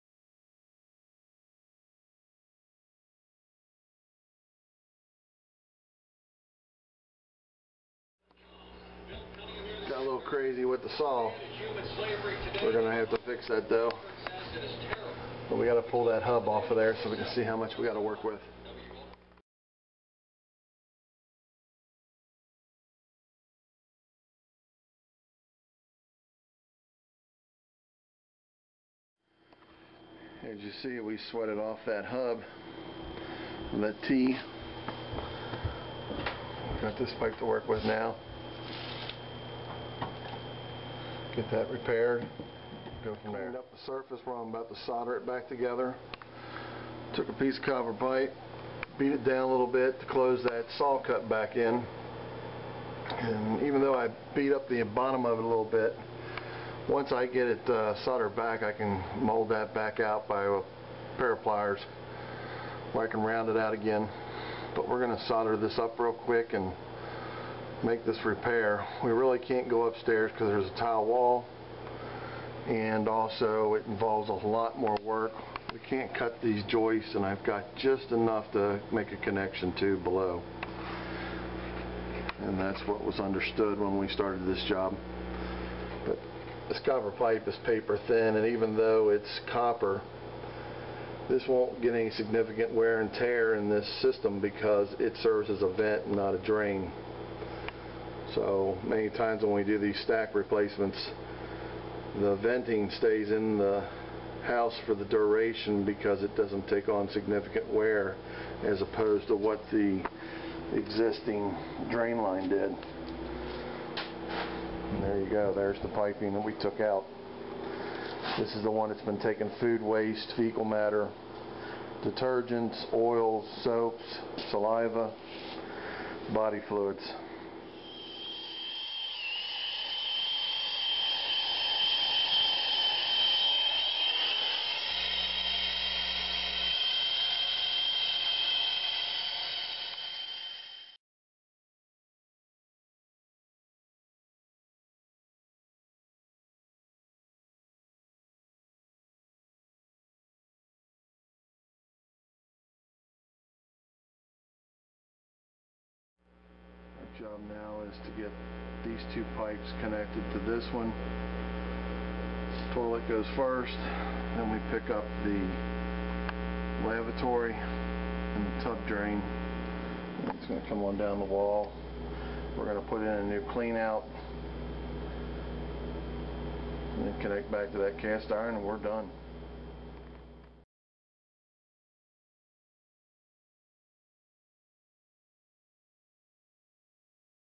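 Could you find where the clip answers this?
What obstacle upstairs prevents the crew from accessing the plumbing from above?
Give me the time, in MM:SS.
01:10.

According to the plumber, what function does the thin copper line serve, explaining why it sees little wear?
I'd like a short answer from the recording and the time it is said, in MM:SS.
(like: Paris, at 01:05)
a vent, at 01:35.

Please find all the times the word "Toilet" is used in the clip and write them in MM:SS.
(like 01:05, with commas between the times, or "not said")
02:42.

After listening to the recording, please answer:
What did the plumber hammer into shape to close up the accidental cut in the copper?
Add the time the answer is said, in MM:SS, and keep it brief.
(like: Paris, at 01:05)
a piece of copper pipe, at 00:47.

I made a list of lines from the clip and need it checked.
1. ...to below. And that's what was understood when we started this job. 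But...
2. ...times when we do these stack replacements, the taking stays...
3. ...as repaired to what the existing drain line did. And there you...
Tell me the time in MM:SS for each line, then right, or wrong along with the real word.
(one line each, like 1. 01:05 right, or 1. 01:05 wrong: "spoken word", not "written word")
1. 01:19 right
2. 01:39 wrong: "venting", not "taking"
3. 01:48 wrong: "opposed", not "repaired".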